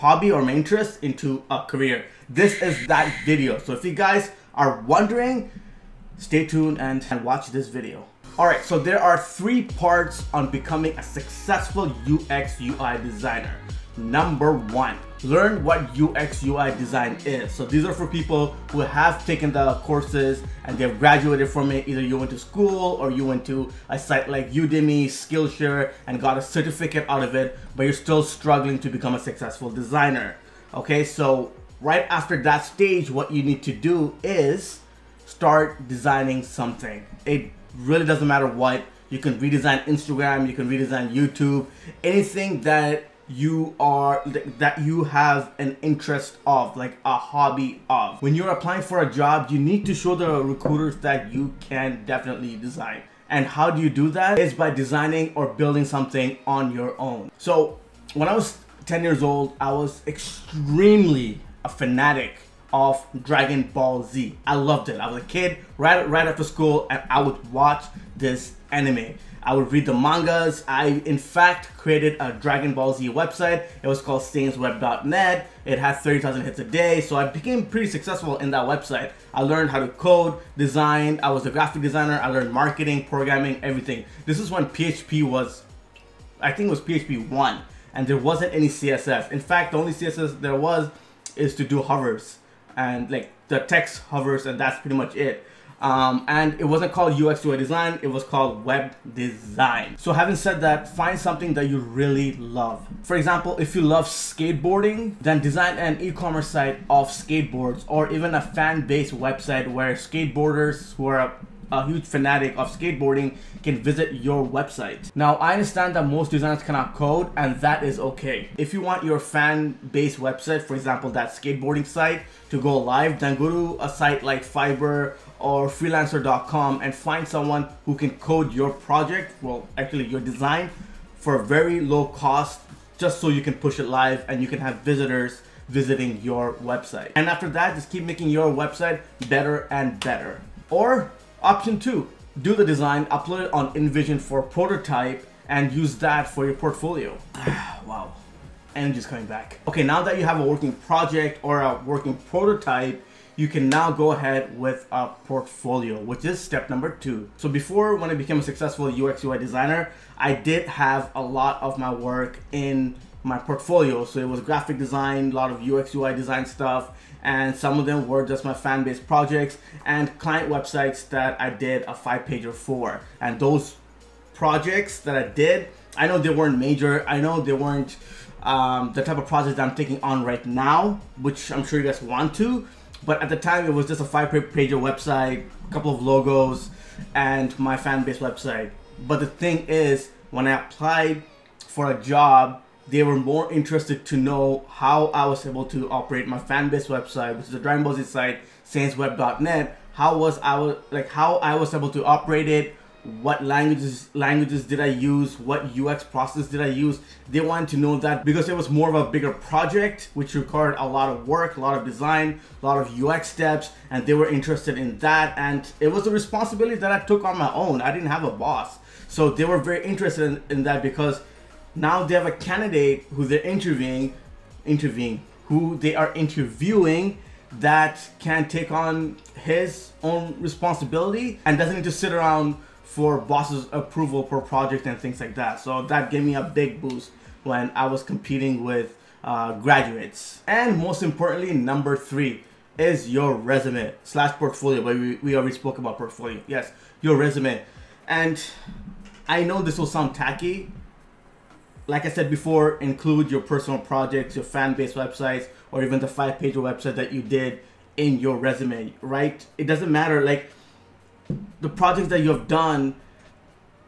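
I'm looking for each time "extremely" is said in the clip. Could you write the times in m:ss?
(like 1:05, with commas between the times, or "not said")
1:00.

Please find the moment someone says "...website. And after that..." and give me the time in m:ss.
2:16.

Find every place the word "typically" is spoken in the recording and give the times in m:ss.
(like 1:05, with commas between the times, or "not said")
not said.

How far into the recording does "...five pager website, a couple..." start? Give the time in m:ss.
3:04.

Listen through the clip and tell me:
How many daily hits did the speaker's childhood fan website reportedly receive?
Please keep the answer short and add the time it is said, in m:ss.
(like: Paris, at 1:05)
30,000, at 1:15.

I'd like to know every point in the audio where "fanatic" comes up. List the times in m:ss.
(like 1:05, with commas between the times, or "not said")
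1:01, 1:52.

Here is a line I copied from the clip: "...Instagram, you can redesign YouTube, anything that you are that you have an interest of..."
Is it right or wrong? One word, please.
right.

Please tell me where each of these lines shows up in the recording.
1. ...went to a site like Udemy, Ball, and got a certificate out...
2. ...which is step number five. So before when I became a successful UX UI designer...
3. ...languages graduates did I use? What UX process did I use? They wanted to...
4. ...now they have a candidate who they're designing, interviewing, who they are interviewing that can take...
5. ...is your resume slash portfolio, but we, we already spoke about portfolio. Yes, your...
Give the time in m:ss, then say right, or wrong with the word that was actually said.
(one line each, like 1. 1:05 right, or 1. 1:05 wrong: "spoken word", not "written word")
1. 0:23 wrong: "Skillshare", not "Ball"
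2. 2:35 wrong: "two", not "five"
3. 3:23 wrong: "languages", not "graduates"
4. 3:41 wrong: "interviewing", not "designing"
5. 4:02 right.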